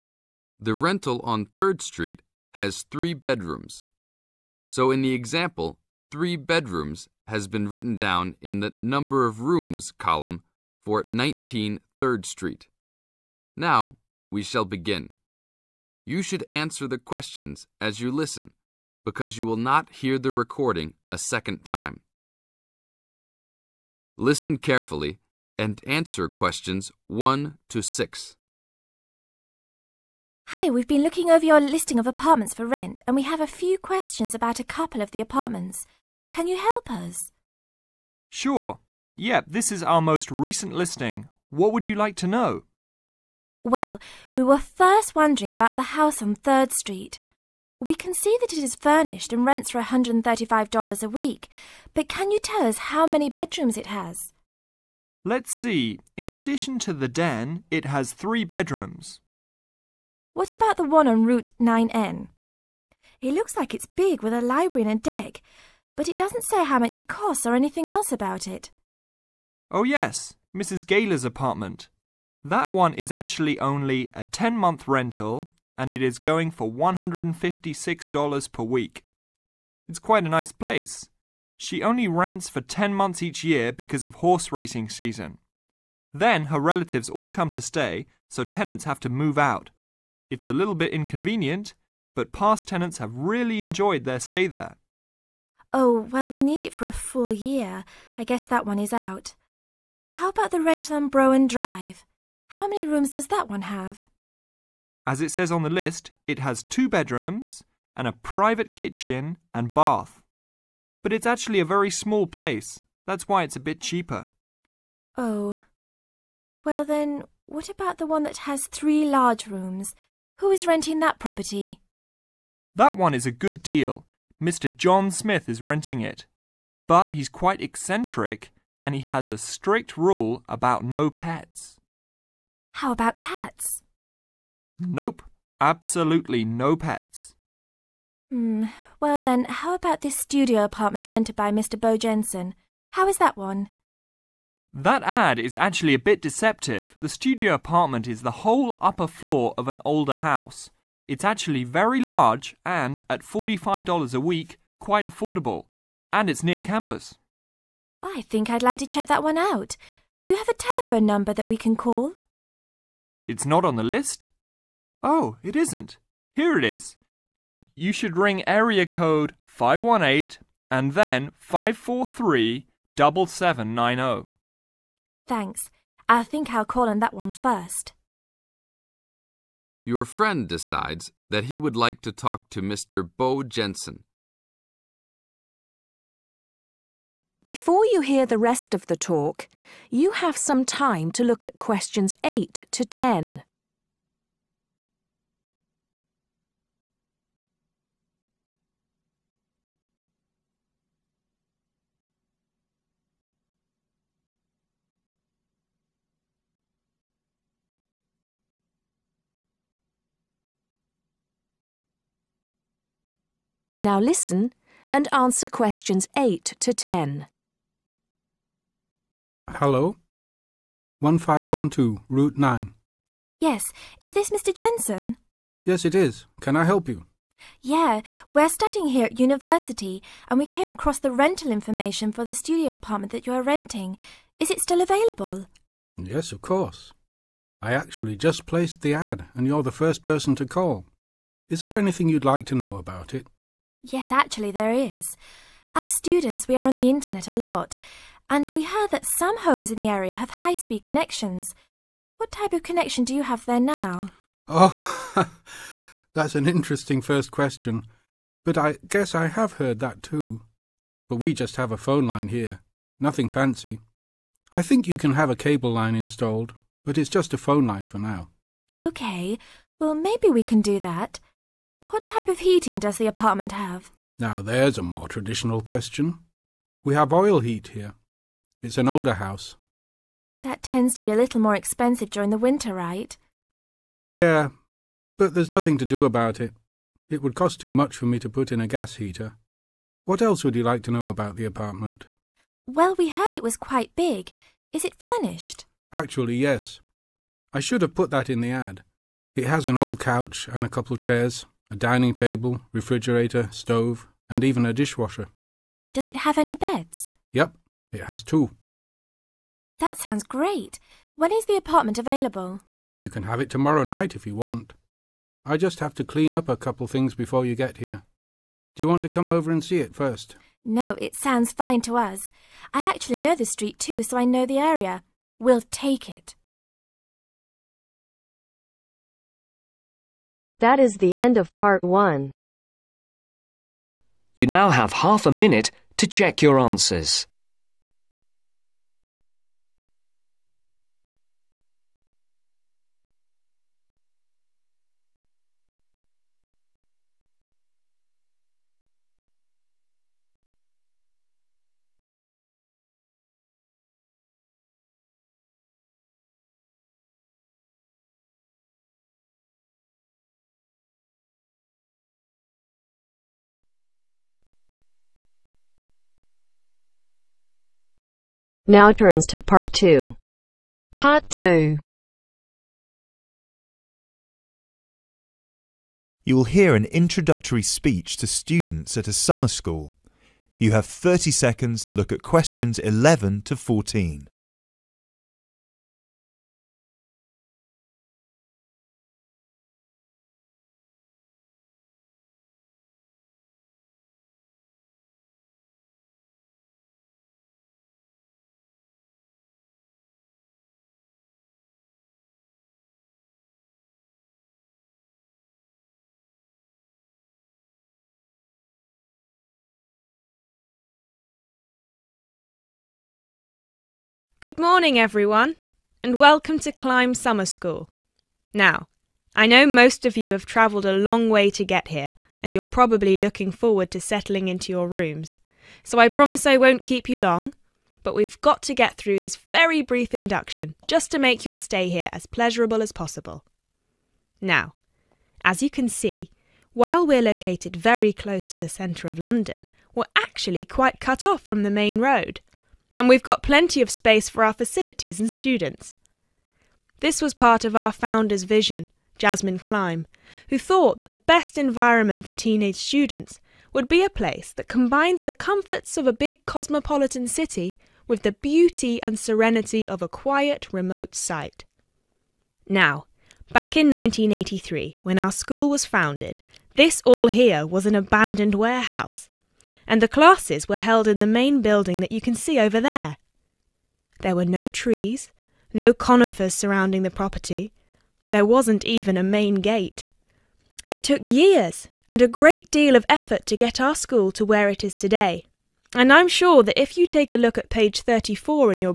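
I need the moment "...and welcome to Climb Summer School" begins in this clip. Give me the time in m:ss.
6:56.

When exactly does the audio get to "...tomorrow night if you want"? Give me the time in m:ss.
5:13.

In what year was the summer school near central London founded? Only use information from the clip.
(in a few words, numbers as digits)
1983.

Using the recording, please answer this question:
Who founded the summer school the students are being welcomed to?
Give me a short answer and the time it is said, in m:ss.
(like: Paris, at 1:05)
Jasmine Klein, at 7:29.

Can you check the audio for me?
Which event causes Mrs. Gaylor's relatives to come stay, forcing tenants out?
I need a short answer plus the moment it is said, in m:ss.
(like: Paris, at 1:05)
horse racing season, at 1:24.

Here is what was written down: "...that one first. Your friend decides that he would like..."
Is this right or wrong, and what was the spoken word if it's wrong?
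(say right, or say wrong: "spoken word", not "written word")
right.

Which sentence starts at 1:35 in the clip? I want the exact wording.
Oh, well, we need it for a full year.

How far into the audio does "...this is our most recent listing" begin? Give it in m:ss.
0:39.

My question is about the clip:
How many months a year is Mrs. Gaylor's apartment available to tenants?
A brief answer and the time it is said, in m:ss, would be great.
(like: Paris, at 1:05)
10 months, at 1:14.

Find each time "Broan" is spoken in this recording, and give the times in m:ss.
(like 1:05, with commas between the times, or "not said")
1:41.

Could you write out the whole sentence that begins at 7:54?
There were no trees, no conifers surrounding the property.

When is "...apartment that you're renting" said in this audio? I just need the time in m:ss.
3:52.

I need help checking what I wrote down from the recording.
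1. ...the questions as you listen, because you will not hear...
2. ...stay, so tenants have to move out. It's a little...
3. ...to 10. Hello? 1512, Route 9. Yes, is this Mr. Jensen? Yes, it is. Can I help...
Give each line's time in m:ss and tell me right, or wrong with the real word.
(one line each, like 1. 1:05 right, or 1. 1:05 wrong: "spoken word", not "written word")
1. 0:16 right
2. 1:27 right
3. 3:36 right.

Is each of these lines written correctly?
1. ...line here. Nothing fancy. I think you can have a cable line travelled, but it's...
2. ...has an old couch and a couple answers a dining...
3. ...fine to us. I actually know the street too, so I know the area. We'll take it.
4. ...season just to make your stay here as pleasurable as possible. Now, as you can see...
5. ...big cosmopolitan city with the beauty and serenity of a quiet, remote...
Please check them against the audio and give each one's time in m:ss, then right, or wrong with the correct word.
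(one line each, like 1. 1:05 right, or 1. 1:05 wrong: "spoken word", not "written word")
1. 4:22 wrong: "installed", not "travelled"
2. 4:59 wrong: "chairs", not "answers"
3. 5:21 right
4. 7:10 wrong: "induction", not "season"
5. 7:36 right.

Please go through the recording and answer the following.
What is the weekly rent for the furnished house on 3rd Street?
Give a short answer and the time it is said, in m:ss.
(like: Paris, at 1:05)
$135, at 0:49.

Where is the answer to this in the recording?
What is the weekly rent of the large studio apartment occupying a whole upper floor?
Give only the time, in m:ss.
2:33.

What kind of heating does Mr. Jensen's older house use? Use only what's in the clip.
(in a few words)
oil heat.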